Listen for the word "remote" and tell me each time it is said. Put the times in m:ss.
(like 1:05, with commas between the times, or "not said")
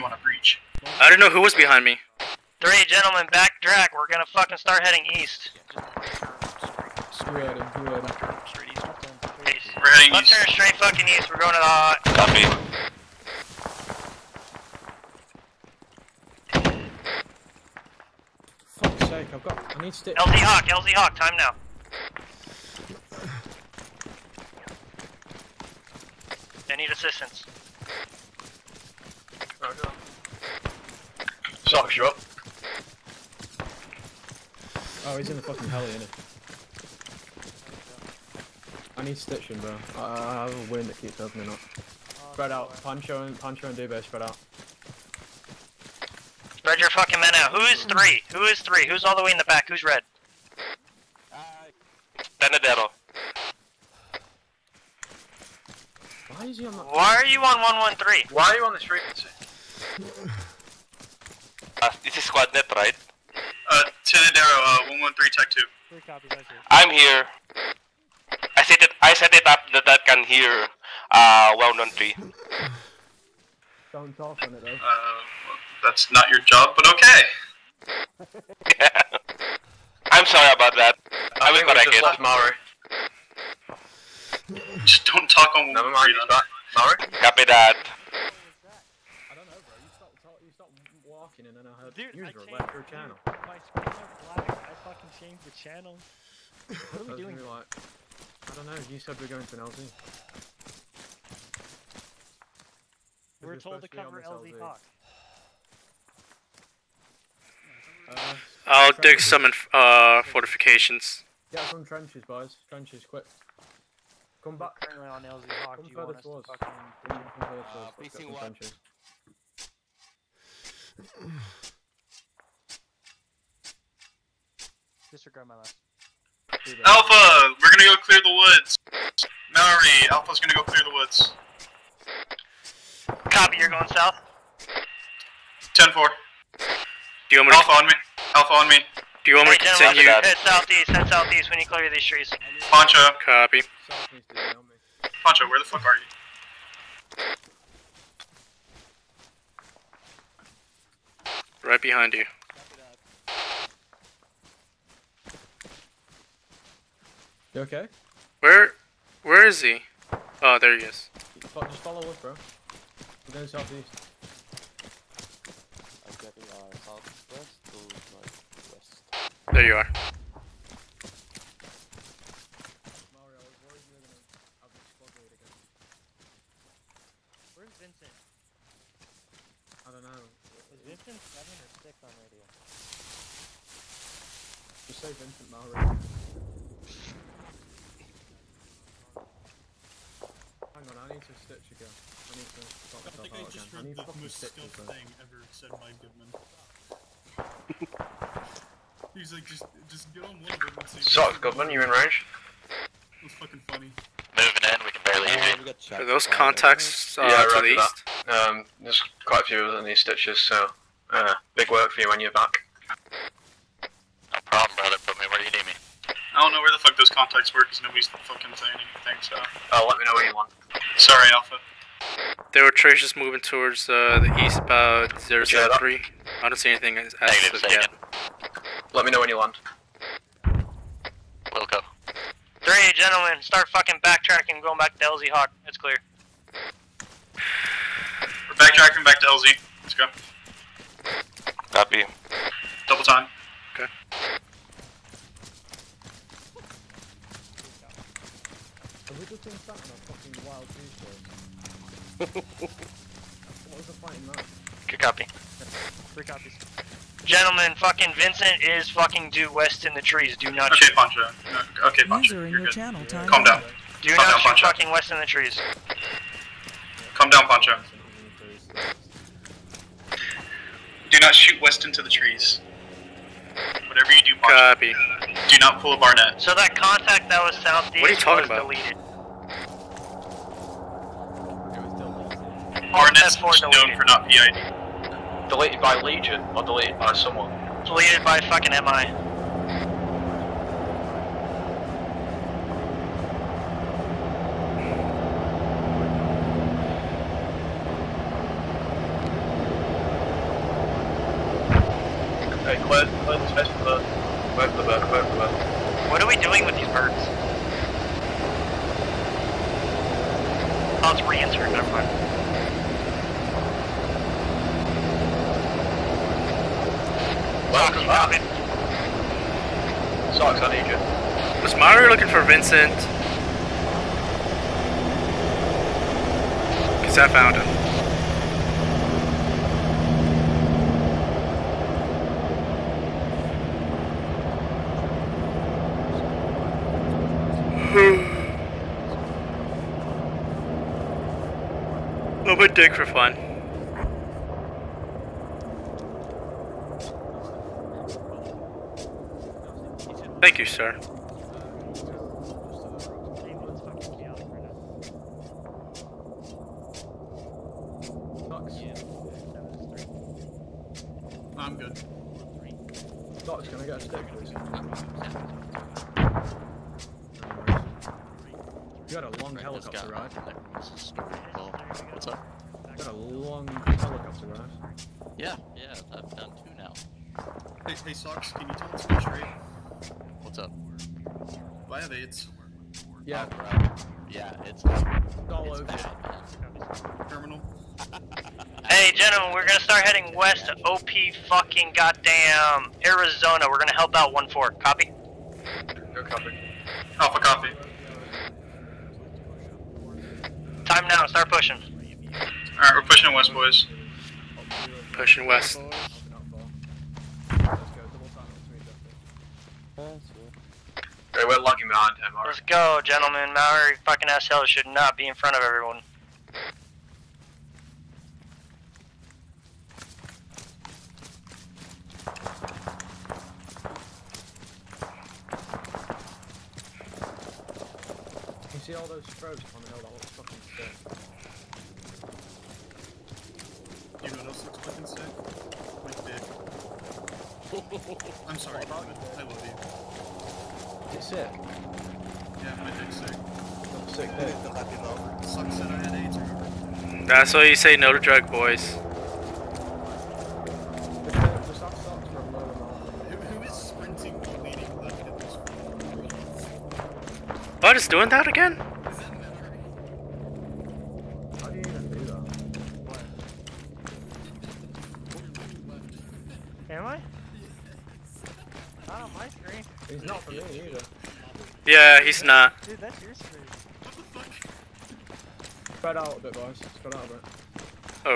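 not said.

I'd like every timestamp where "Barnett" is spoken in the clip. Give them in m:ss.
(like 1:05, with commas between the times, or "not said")
4:35, 4:42.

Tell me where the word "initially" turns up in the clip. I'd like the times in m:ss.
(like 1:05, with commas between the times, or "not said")
not said.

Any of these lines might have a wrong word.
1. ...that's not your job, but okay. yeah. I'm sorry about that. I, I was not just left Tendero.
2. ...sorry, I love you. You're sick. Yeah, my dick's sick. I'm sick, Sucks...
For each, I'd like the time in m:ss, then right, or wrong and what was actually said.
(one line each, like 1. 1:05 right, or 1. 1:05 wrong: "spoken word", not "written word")
1. 1:15 wrong: "Maori", not "Tendero"
2. 7:18 right.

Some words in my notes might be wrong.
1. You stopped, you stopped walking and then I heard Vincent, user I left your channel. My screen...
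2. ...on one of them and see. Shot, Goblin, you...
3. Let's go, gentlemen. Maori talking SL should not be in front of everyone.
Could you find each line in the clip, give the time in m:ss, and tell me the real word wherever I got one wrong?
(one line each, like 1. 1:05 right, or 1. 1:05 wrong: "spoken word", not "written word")
1. 1:29 wrong: "Dude", not "Vincent"
2. 3:20 right
3. 6:52 wrong: "fucking", not "talking".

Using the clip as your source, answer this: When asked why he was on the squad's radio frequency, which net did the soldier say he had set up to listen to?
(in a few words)
113 TAC 2.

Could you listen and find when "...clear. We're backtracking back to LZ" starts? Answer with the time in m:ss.
3:55.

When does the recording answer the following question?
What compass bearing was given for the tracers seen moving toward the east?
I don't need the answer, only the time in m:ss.
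3:45.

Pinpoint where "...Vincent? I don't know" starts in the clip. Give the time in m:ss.
2:57.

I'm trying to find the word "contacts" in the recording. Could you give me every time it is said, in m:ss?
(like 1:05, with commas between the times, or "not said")
3:26, 3:37, 4:36.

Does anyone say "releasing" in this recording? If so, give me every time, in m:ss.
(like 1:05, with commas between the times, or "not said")
not said.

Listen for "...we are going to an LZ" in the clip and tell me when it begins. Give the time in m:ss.
1:39.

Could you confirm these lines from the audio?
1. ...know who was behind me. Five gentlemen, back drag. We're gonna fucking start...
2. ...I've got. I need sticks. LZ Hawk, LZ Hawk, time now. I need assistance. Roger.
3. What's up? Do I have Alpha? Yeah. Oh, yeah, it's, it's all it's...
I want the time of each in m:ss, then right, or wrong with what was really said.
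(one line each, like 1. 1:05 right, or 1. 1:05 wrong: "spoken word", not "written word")
1. 0:01 wrong: "Three", not "Five"
2. 0:19 right
3. 6:20 wrong: "AIDS", not "Alpha".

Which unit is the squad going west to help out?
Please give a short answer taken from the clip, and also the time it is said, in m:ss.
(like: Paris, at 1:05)
1-4, at 6:34.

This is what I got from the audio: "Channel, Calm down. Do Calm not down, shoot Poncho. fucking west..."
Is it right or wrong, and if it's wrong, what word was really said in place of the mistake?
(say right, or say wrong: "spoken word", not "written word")
right.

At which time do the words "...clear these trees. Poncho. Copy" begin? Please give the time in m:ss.
2:21.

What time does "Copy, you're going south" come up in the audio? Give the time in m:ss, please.
2:13.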